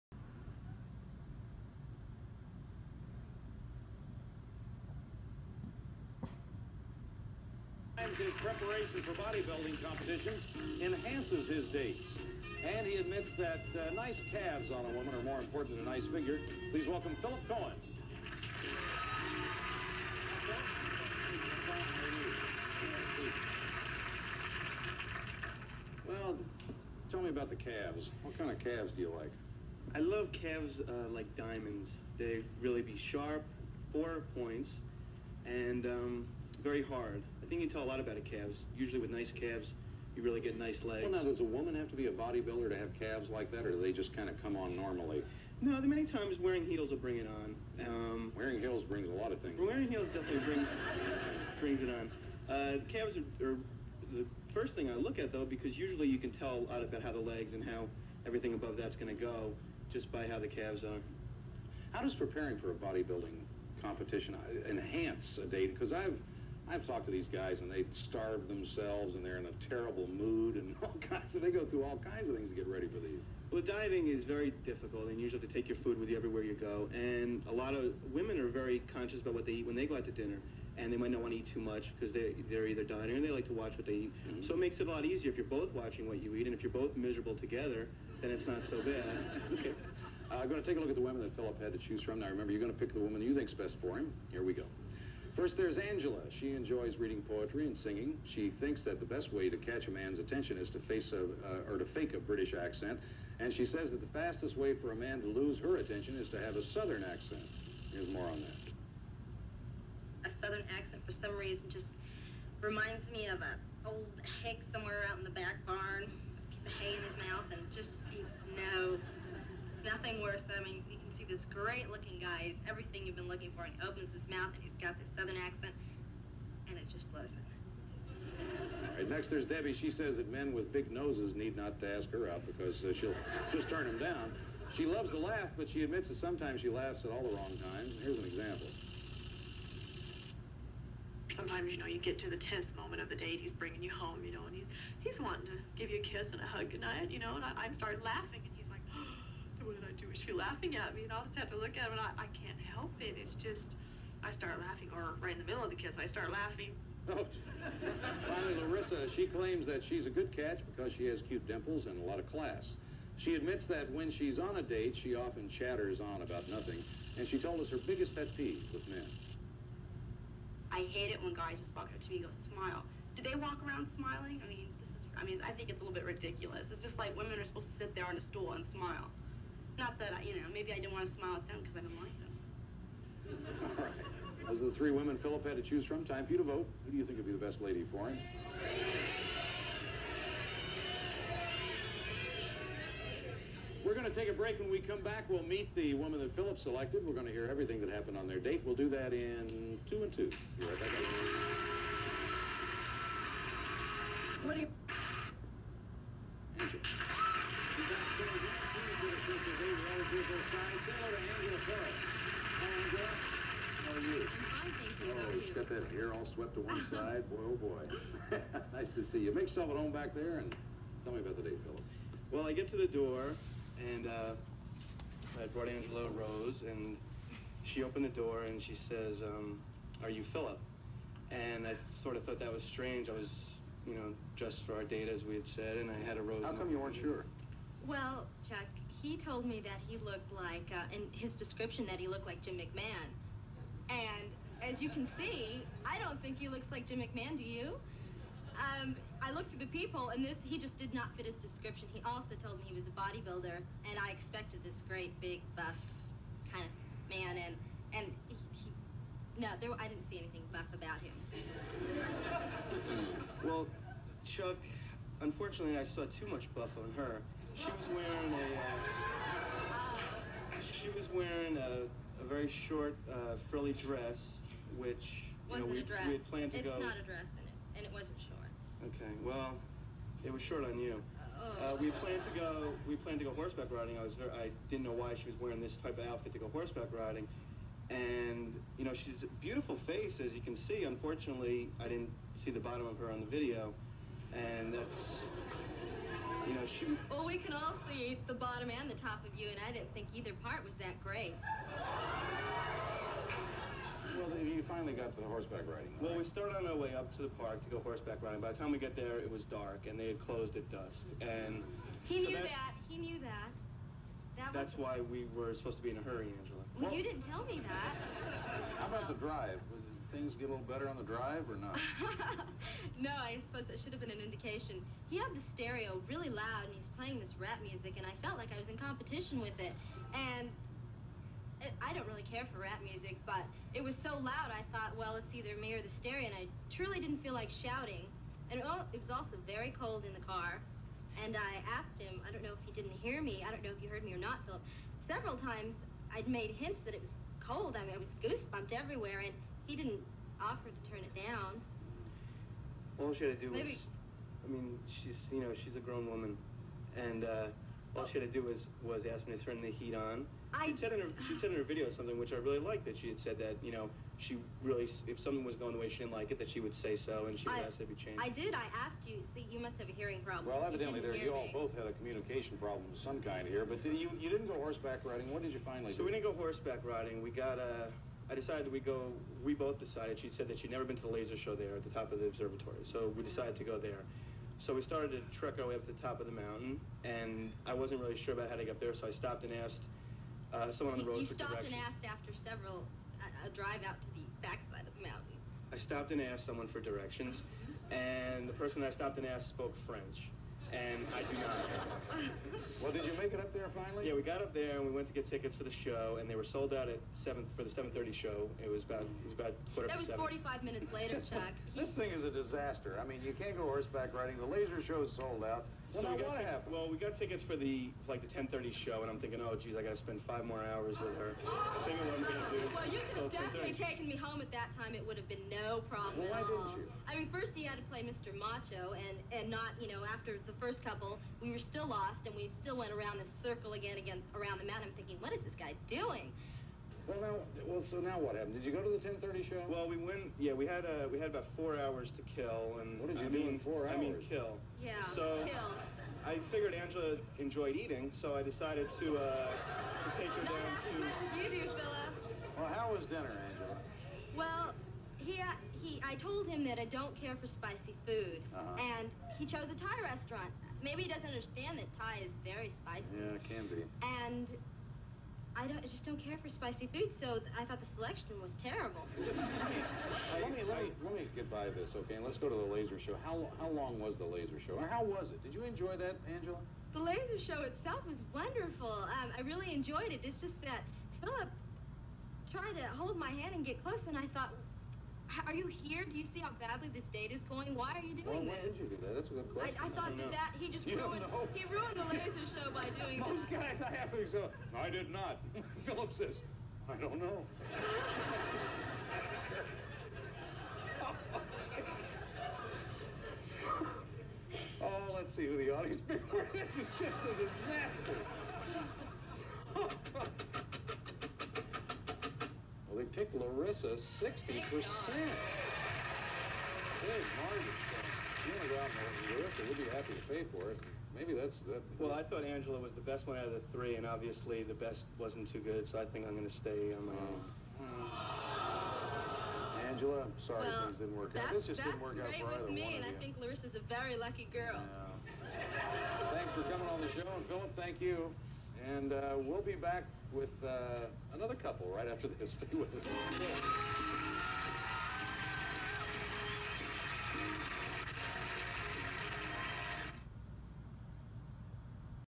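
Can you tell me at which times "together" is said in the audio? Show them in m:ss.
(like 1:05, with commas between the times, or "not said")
1:27.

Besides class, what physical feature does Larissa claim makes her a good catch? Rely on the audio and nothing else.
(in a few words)
Cute dimples.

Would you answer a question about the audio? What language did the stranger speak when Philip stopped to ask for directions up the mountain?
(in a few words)
French.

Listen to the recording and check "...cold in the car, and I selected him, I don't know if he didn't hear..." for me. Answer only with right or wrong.
wrong.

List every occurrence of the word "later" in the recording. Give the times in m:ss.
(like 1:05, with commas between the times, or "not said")
6:50.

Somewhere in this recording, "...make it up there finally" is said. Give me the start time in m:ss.
6:43.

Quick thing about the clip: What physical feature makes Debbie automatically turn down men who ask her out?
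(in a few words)
Big noses.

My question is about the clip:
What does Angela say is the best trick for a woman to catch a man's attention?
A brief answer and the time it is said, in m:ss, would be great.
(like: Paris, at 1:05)
Fake a British accent, at 1:41.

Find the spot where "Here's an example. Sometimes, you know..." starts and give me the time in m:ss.
2:18.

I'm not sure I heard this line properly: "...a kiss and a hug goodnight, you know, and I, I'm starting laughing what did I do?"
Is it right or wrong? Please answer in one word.
right.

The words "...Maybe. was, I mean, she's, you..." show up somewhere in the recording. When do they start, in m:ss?
5:53.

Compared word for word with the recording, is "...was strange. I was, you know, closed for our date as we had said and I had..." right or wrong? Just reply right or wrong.
wrong.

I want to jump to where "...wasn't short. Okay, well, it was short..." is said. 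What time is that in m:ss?
4:37.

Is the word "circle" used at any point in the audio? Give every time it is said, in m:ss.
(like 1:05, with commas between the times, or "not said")
7:13.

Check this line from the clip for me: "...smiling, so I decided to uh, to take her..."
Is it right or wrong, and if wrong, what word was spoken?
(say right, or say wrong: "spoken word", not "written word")
wrong: "eating", not "smiling".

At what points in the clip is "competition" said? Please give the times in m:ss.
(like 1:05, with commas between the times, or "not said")
0:09, 1:03, 5:28.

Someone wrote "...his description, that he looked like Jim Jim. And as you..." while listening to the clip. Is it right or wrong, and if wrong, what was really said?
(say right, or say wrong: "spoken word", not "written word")
wrong: "McMahon", not "Jim".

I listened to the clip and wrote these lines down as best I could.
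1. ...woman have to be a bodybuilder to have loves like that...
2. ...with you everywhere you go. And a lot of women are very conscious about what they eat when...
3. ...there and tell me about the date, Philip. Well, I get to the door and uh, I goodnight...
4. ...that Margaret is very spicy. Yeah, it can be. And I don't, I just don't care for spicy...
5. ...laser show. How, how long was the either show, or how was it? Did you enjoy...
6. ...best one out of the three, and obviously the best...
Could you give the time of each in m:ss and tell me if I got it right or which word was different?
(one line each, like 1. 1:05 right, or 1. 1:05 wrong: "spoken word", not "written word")
1. 0:41 wrong: "calves", not "loves"
2. 1:15 right
3. 3:40 wrong: "brought", not "goodnight"
4. 7:41 wrong: "Thai", not "Margaret"
5. 7:52 wrong: "laser", not "either"
6. 8:43 right.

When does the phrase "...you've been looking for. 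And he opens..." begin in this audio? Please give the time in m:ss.
2:03.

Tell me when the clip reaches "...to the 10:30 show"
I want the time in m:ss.
7:18.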